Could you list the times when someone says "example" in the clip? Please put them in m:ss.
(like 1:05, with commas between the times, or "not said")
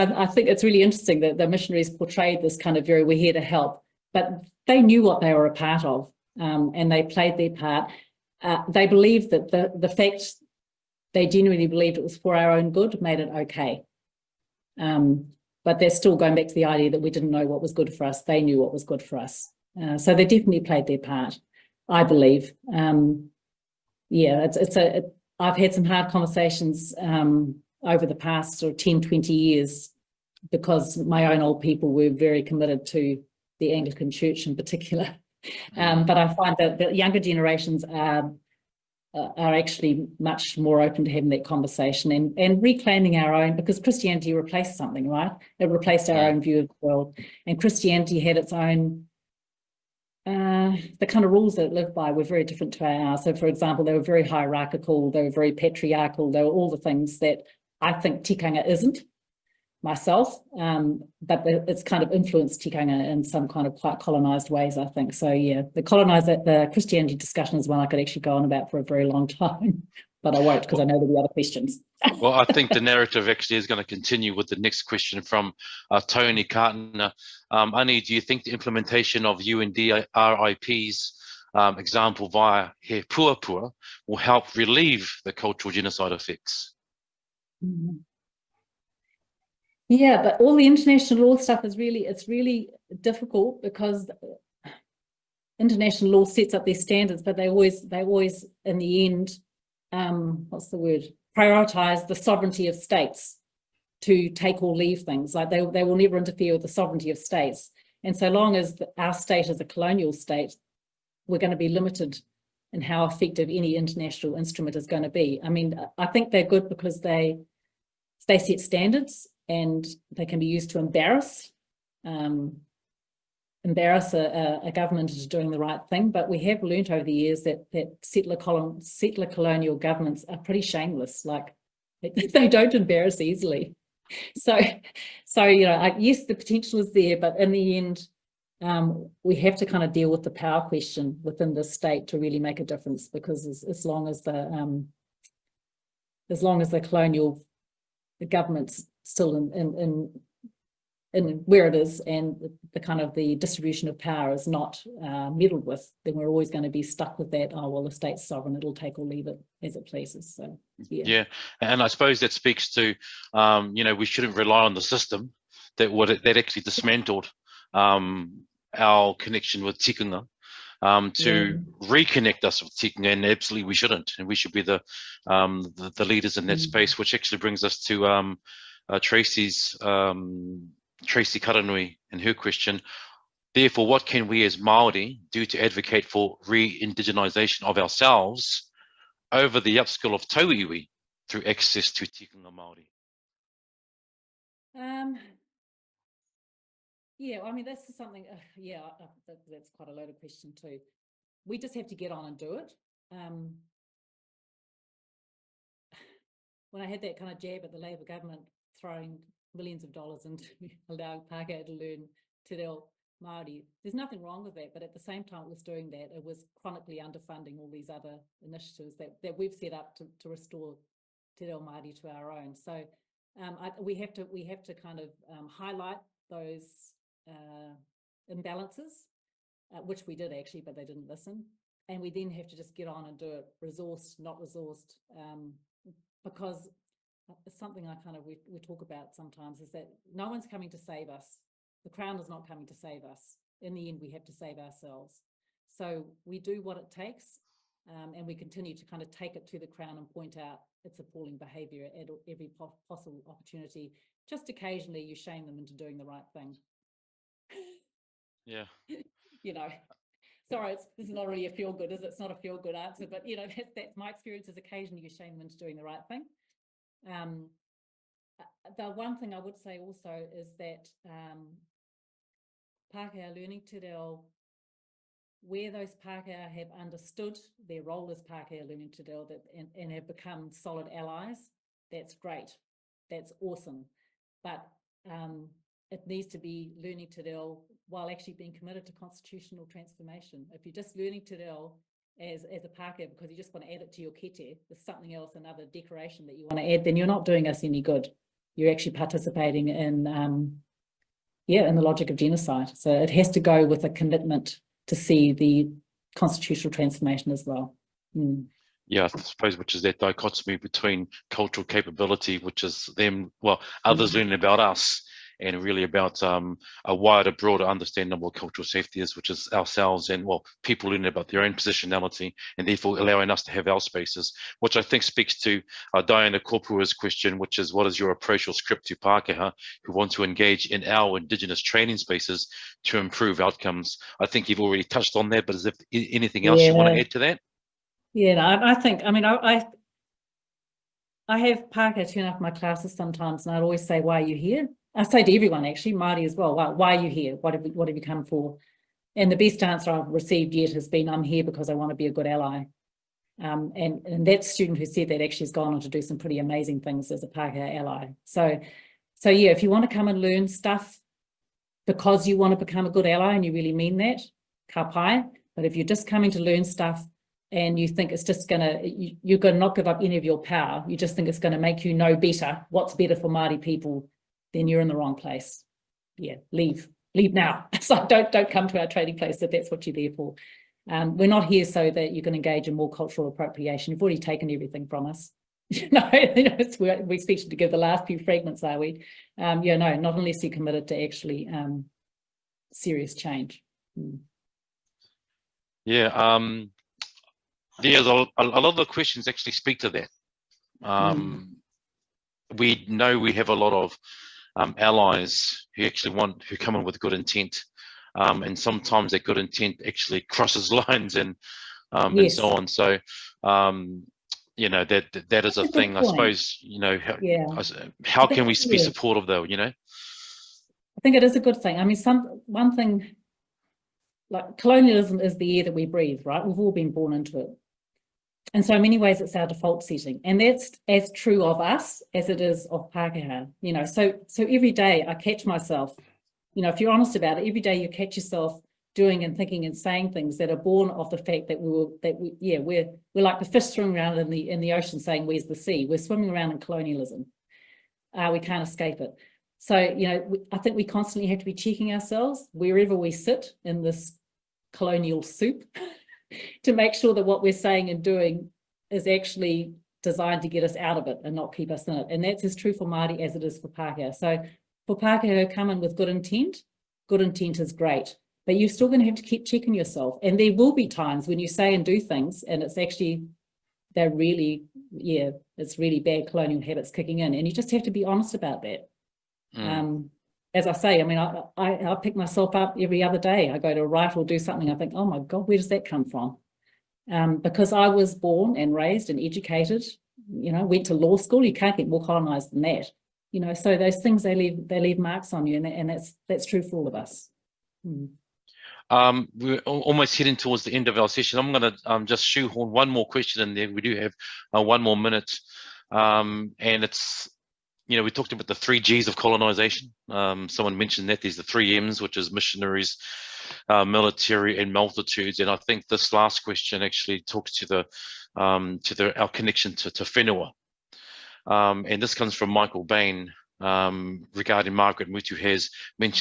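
0:53, 1:21.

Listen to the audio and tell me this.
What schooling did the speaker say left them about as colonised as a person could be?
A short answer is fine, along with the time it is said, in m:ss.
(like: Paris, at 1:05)
law school, at 8:10.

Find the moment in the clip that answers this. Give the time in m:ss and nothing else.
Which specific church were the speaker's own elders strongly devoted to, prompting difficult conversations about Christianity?
0:33.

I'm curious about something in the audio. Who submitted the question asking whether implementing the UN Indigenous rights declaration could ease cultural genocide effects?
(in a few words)
Tony Cartner.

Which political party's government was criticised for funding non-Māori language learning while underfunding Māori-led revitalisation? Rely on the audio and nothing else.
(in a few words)
Labour.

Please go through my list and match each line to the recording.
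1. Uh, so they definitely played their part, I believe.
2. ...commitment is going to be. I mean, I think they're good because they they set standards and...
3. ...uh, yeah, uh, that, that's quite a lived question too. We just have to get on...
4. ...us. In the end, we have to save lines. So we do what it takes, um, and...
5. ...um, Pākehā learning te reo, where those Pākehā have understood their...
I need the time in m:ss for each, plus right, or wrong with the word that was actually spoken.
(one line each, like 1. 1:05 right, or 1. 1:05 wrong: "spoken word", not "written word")
1. 0:19 right
2. 1:54 wrong: "instrument", not "commitment"
3. 3:18 wrong: "loaded", not "lived"
4. 4:03 wrong: "ourselves", not "lines"
5. 4:31 right.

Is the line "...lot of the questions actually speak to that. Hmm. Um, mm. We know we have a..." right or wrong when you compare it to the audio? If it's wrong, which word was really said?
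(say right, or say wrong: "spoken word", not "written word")
right.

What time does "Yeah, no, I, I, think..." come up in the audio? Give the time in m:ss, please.
5:38.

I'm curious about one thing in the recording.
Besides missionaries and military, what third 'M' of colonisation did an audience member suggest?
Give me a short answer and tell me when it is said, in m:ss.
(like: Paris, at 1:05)
multitudes, at 8:34.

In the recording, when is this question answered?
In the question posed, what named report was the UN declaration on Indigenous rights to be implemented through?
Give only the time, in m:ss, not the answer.
1:22.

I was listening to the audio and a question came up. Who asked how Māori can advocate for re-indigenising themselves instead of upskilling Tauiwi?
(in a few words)
Tracy Karanui.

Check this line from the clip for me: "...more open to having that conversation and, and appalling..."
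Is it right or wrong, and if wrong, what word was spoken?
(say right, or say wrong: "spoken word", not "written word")
wrong: "reclaiming", not "appalling".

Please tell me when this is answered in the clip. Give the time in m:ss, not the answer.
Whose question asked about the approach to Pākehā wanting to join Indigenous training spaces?
5:26.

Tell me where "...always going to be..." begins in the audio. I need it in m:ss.
2:36.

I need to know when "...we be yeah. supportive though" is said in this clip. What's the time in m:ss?
6:58.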